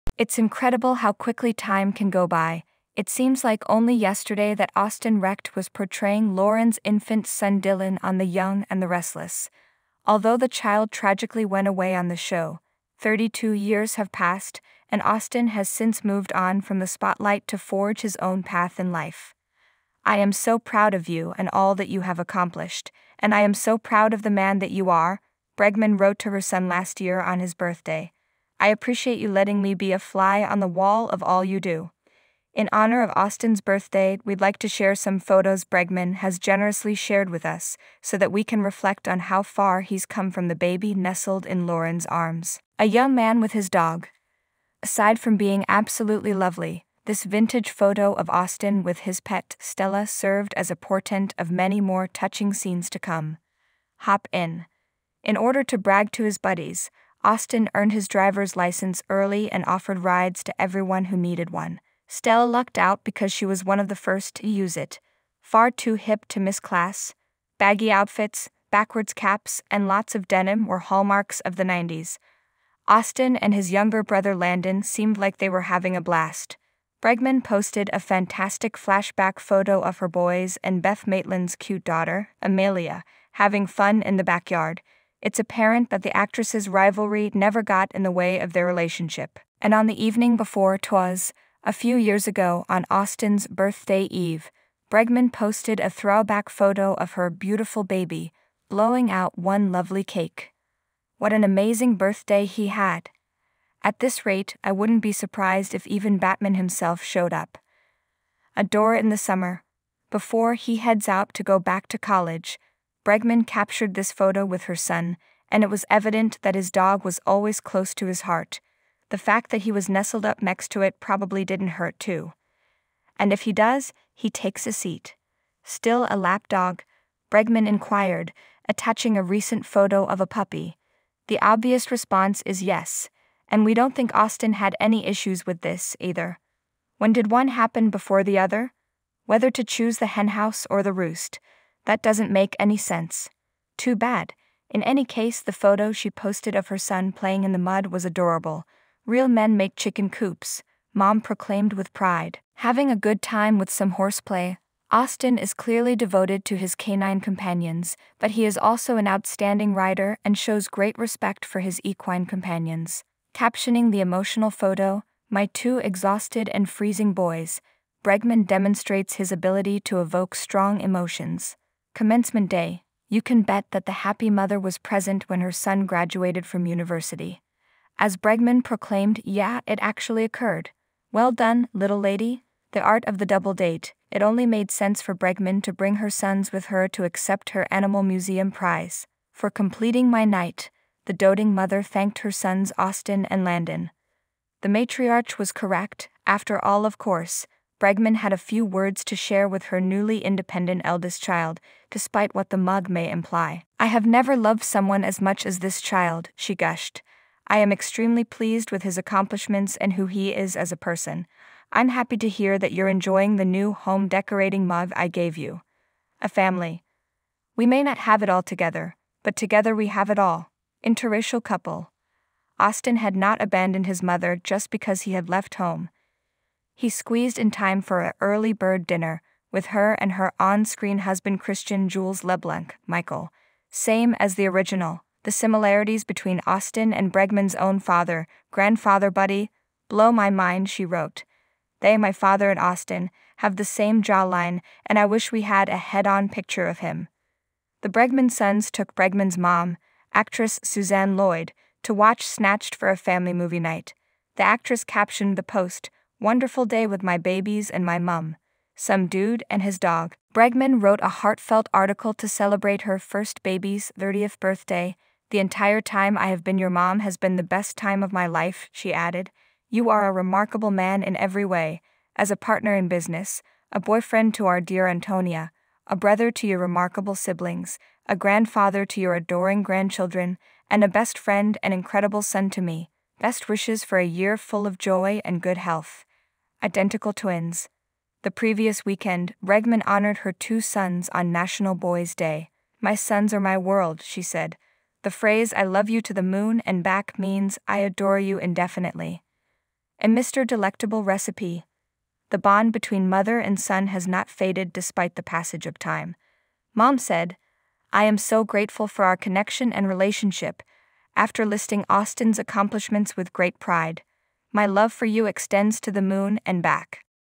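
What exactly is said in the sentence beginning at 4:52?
My sons are my world, she said.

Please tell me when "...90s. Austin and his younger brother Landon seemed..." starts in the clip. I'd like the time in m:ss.
1:11.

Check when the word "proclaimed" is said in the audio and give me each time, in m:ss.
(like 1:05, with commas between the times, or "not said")
2:31, 2:58.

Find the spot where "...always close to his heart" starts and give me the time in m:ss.
1:57.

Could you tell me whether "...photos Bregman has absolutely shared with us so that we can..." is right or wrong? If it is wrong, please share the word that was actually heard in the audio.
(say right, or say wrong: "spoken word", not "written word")
wrong: "generously", not "absolutely".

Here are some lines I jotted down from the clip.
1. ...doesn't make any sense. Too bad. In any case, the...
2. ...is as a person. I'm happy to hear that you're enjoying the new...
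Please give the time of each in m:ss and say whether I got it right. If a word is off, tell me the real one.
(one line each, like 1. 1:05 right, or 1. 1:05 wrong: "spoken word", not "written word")
1. 2:22 right
2. 3:30 right.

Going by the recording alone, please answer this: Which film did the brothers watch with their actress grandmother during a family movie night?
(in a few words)
Snatched.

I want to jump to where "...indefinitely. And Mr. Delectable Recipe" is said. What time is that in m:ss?
4:58.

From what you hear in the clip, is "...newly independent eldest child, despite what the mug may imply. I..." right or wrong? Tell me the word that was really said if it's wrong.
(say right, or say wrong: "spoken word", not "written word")
right.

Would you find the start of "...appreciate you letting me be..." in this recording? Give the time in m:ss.
0:28.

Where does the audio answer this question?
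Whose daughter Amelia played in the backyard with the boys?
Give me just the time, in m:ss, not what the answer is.
1:20.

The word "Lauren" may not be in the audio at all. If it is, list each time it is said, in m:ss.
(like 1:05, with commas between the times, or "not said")
0:06, 0:41.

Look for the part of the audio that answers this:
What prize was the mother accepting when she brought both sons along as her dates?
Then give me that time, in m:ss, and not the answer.
3:07.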